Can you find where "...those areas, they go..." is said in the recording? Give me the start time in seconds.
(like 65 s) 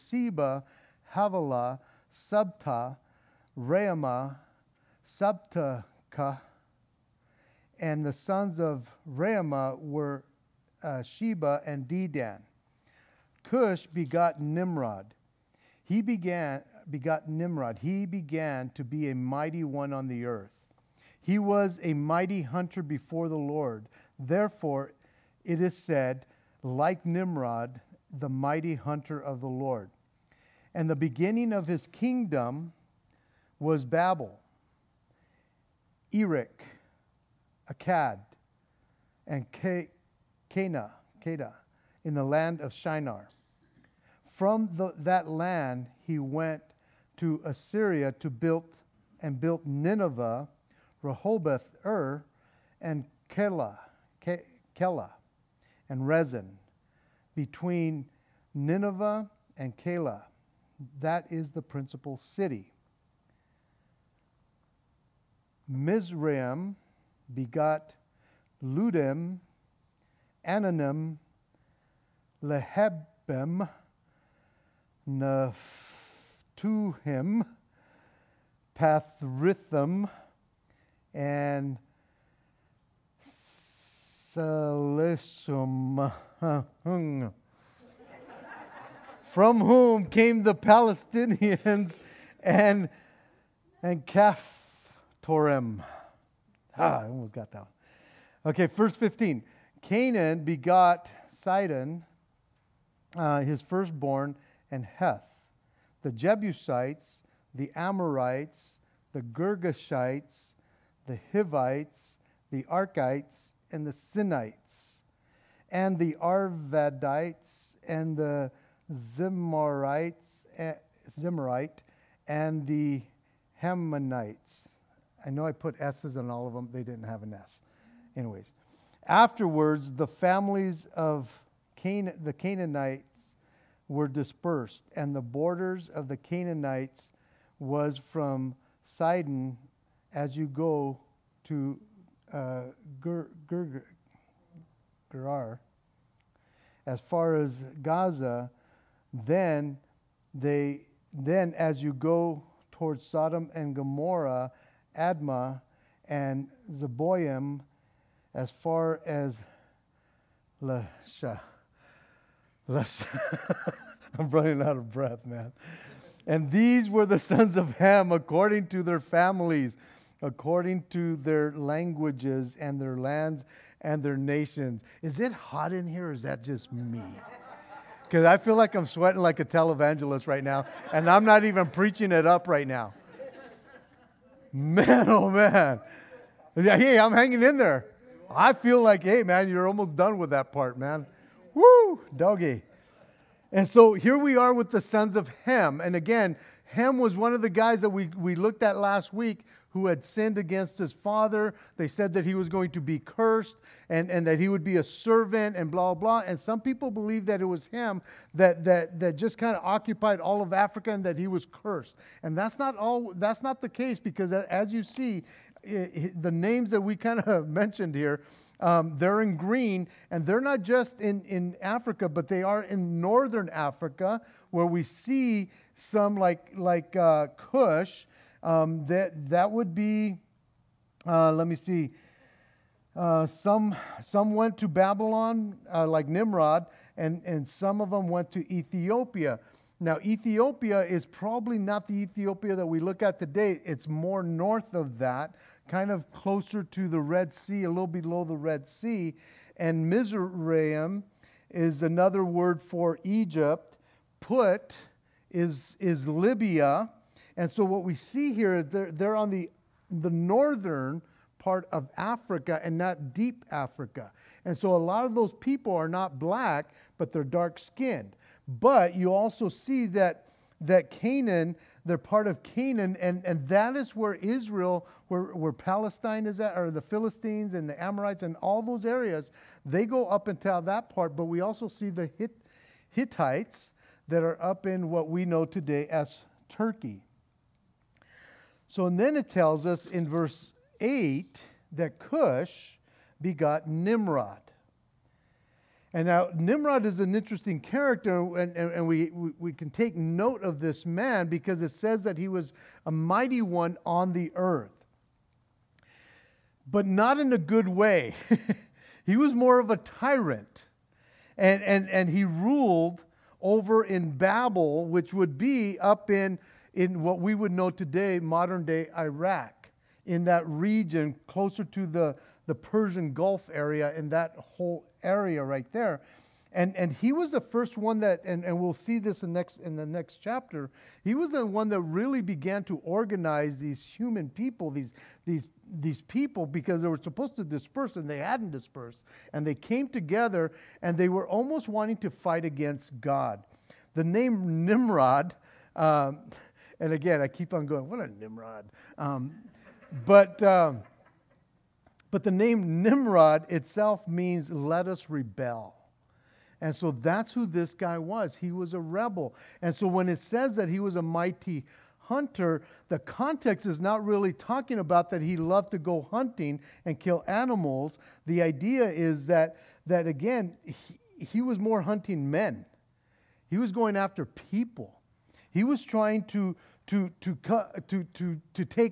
278 s.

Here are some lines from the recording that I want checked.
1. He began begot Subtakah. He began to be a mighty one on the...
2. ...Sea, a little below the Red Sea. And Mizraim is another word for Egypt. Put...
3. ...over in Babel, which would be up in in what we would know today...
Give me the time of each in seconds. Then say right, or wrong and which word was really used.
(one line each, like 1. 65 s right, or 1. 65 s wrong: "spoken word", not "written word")
1. 15 s wrong: "Nimrod", not "Subtakah"
2. 247 s right
3. 313 s right.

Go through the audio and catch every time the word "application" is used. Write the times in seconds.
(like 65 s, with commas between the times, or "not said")
not said.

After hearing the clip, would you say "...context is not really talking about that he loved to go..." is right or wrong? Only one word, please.
right.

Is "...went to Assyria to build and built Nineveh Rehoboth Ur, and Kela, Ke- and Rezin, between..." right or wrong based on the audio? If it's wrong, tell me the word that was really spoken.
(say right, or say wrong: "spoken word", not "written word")
right.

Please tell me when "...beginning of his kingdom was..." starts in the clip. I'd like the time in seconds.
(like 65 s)
30 s.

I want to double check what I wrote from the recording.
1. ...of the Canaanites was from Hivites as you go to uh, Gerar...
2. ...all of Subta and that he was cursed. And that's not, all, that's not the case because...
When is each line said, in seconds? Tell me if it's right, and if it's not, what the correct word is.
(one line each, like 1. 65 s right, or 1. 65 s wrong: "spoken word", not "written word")
1. 135 s wrong: "Sidon", not "Hivites"
2. 210 s wrong: "Africa", not "Subta".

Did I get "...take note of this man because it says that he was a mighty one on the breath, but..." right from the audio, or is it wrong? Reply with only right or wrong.
wrong.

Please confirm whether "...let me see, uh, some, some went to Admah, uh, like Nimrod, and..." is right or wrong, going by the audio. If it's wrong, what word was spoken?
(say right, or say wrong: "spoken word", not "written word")
wrong: "Babylon", not "Admah".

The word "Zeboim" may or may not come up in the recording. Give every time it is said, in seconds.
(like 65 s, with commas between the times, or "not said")
156 s.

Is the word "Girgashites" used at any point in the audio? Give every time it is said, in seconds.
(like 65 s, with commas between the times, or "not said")
109 s.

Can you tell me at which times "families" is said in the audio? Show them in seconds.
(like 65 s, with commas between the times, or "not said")
130 s, 169 s.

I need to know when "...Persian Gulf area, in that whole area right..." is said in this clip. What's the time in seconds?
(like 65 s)
322 s.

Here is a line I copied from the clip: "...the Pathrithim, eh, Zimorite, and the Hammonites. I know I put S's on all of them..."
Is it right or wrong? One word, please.
wrong.